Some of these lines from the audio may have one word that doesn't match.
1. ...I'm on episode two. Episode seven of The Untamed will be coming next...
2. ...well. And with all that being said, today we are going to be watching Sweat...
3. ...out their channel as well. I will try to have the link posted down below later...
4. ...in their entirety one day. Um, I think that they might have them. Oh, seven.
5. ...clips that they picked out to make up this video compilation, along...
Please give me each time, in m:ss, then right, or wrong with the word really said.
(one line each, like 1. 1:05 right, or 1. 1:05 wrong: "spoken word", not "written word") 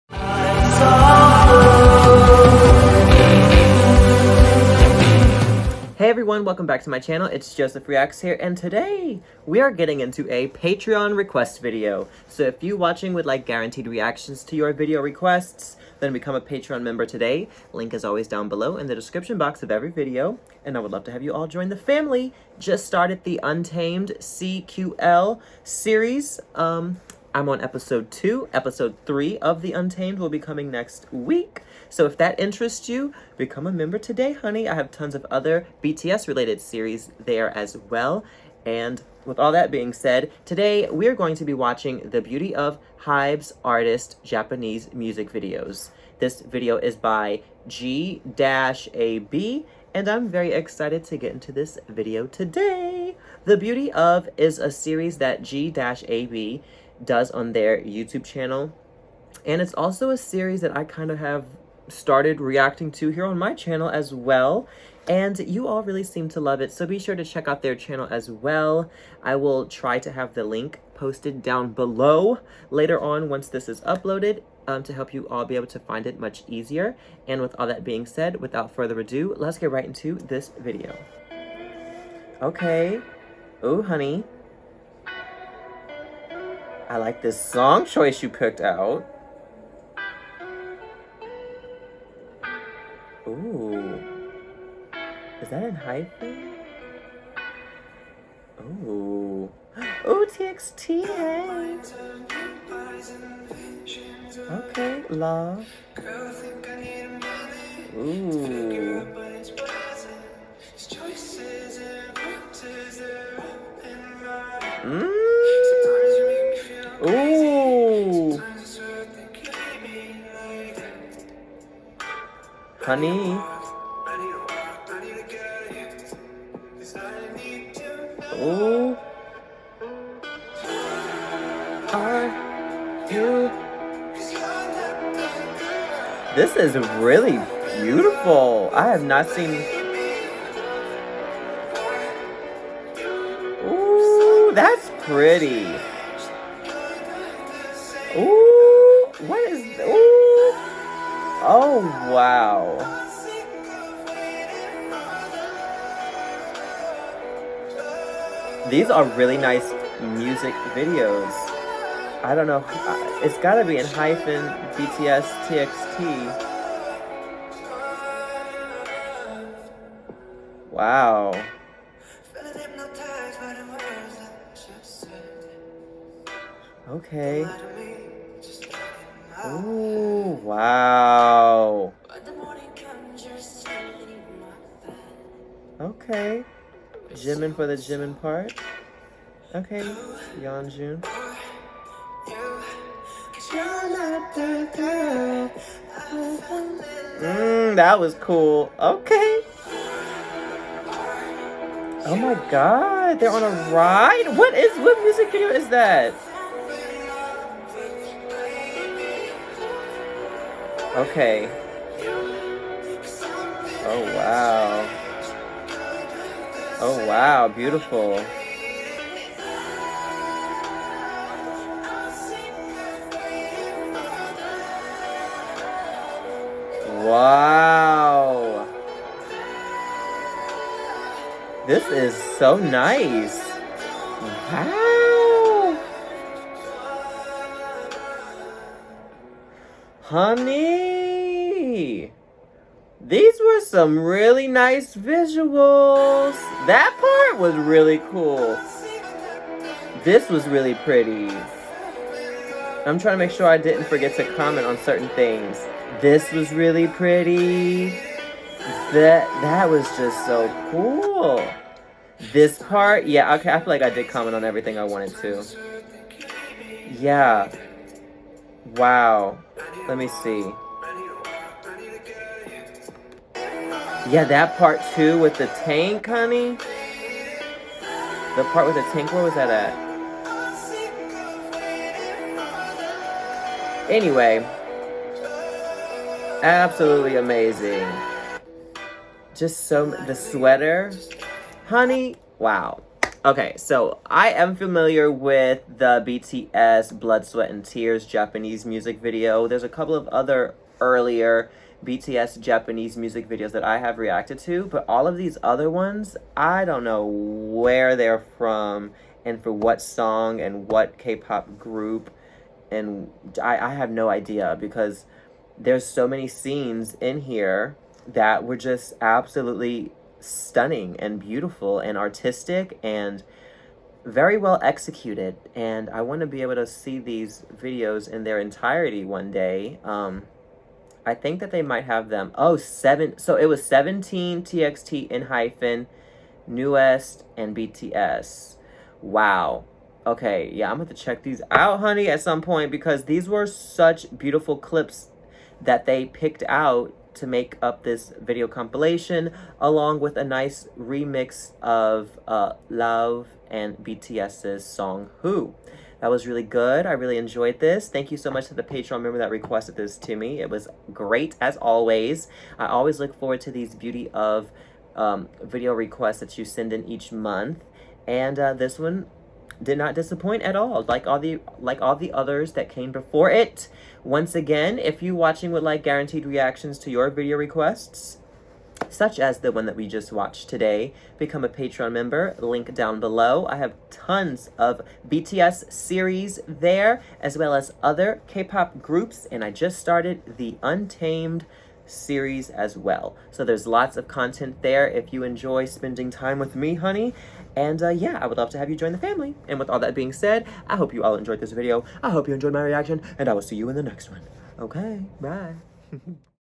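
1. 0:27 wrong: "three", not "seven"
2. 0:37 wrong: "The", not "Sweat"
3. 1:07 right
4. 5:28 right
5. 5:44 right.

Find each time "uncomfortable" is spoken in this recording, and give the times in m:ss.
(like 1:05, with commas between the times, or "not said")
not said.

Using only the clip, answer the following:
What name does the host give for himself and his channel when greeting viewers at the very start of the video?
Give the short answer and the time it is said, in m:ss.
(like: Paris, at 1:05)
Joseph Reacts, at 0:07.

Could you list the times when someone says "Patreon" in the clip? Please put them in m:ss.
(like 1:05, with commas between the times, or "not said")
0:10, 0:16, 5:58, 6:21.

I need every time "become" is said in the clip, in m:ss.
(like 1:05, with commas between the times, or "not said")
0:16, 0:33, 6:21.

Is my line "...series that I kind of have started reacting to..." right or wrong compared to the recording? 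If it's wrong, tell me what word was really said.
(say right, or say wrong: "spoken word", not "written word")
right.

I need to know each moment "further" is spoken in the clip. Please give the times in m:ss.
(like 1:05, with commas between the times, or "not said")
1:18.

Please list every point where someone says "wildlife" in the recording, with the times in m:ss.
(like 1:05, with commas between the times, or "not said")
not said.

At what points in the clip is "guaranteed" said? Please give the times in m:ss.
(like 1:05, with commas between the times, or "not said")
0:13, 6:15.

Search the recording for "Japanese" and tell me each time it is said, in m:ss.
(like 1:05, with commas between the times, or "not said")
0:44, 4:58, 5:02.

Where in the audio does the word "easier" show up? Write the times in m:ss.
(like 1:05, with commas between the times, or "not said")
1:16.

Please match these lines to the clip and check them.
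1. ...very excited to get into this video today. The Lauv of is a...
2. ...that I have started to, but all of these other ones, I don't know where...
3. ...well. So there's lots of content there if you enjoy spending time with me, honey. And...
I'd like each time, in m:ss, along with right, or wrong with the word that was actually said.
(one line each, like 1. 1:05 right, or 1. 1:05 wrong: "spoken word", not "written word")
1. 0:50 wrong: "Beauty", not "Lauv"
2. 5:03 wrong: "reacted", not "started"
3. 6:32 right.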